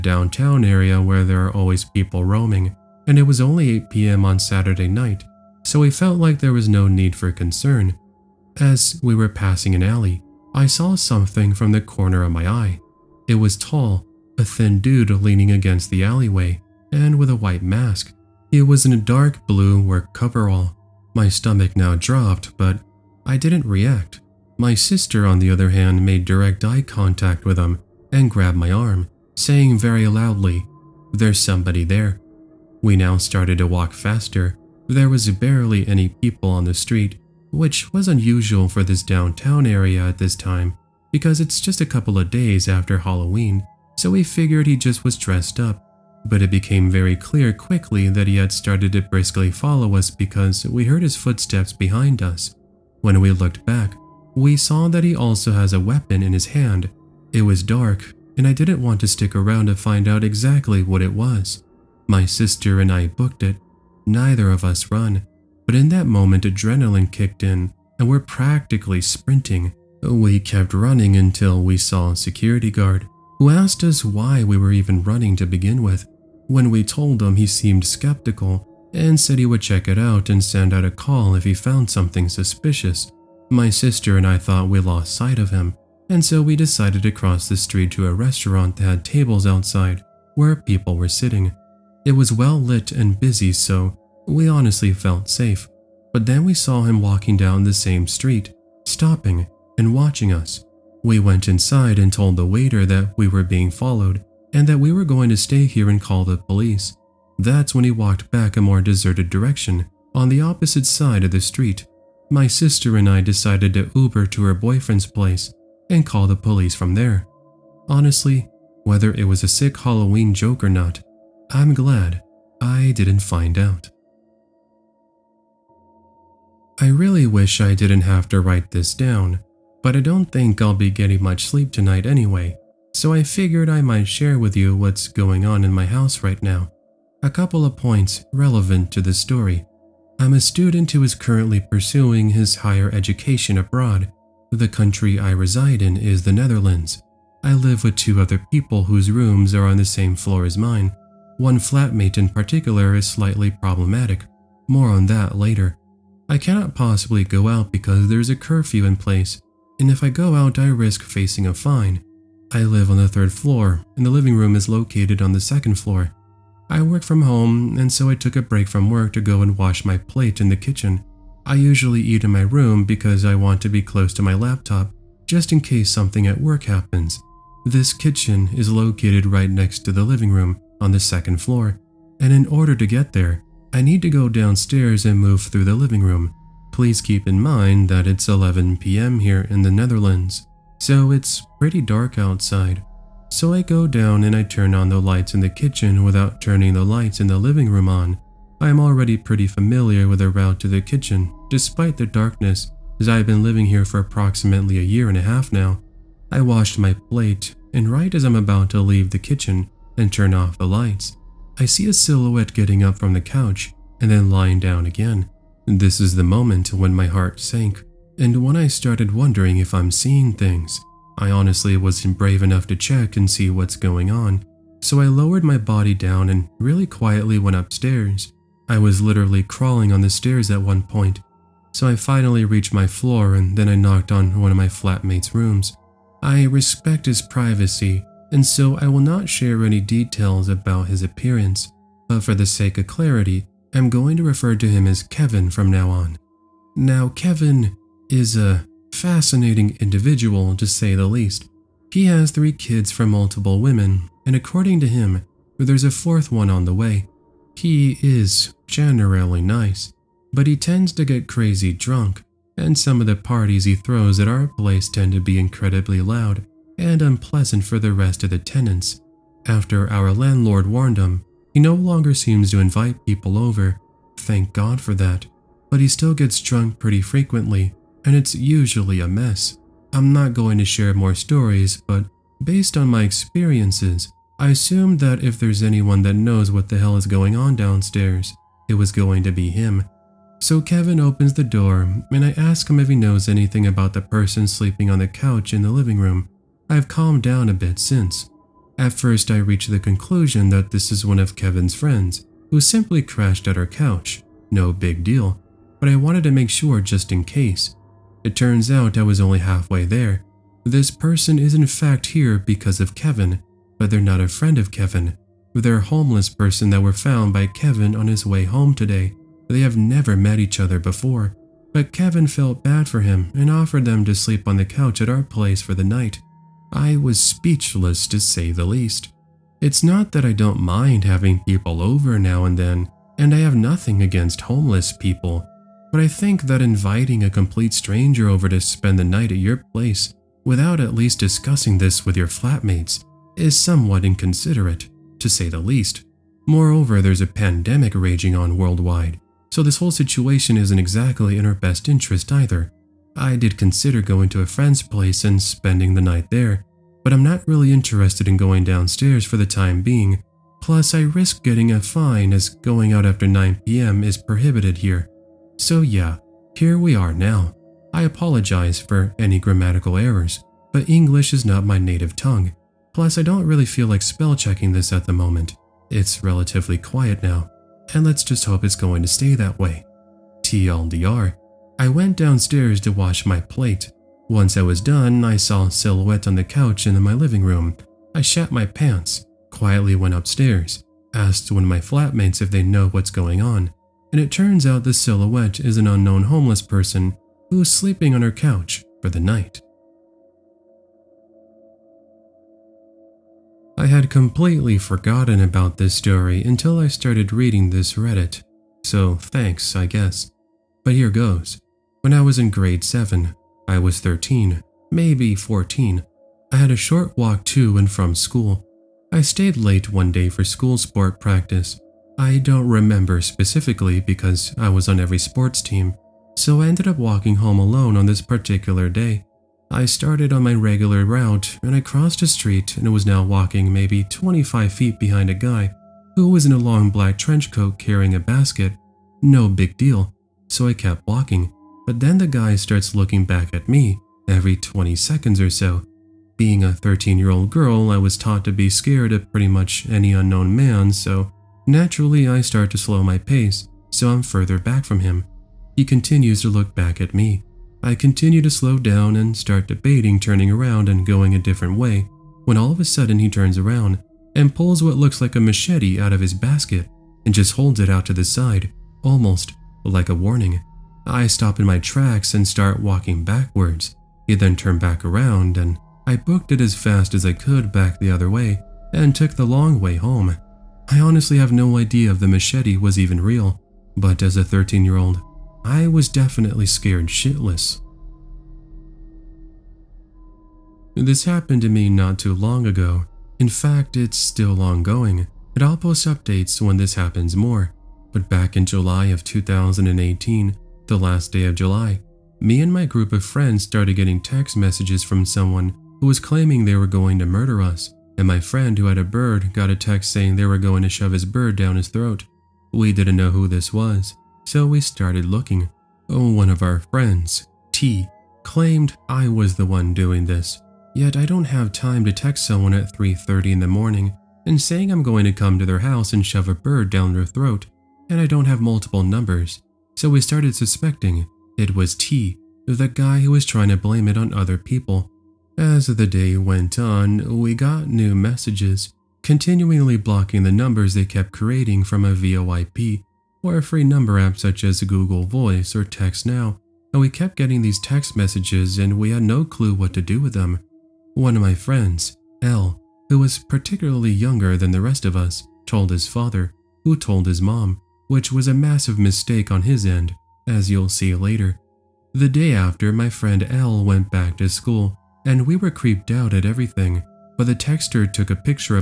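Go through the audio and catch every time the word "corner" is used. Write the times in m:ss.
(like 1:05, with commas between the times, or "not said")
0:11.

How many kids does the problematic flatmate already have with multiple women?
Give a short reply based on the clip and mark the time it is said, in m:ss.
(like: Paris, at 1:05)
3, at 4:12.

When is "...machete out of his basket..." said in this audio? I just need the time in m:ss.
7:45.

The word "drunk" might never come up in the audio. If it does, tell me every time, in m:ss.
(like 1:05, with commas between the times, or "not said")
4:21, 4:36.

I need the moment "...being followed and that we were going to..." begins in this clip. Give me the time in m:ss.
1:43.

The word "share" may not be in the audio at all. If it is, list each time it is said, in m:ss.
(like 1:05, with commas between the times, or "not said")
2:14, 3:59, 4:40.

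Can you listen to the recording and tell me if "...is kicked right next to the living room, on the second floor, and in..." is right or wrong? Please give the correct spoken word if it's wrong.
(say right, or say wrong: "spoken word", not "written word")
wrong: "located", not "kicked".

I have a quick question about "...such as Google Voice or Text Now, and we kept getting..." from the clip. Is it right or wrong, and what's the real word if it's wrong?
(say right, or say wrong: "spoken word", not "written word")
right.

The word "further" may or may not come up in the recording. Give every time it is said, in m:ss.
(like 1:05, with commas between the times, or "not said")
7:34.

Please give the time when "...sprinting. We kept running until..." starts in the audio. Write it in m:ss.
1:09.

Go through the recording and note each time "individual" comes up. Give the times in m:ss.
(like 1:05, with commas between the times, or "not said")
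4:09.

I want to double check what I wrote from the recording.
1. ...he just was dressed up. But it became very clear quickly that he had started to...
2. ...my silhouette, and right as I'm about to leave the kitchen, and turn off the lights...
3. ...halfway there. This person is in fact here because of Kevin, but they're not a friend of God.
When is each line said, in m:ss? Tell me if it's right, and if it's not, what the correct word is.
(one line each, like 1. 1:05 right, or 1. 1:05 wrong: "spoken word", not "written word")
1. 0:44 right
2. 3:26 wrong: "plate", not "silhouette"
3. 5:09 wrong: "Kevin", not "God".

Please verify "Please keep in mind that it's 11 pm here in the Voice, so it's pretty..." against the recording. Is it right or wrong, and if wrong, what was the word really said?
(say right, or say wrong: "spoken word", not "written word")
wrong: "Netherlands", not "Voice".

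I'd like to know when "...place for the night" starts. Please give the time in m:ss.
5:25.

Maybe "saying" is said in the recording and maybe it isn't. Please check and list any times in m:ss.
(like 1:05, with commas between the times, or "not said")
0:29, 8:30, 8:44.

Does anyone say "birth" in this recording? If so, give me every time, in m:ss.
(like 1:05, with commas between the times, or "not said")
not said.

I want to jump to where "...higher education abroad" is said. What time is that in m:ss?
2:22.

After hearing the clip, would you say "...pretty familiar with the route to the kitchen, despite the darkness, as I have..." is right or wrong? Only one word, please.
right.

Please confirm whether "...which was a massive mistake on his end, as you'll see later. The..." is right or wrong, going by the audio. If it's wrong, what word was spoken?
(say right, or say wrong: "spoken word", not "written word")
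right.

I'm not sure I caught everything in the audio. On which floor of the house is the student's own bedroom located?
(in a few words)
third floor.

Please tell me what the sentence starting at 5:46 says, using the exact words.
Moreover, there's a pandemic raging on worldwide, so this whole situation isn't exactly in our best interest either.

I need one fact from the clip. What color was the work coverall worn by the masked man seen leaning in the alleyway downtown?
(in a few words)
dark blue.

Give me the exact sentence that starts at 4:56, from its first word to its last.
I've calmed down a bit since.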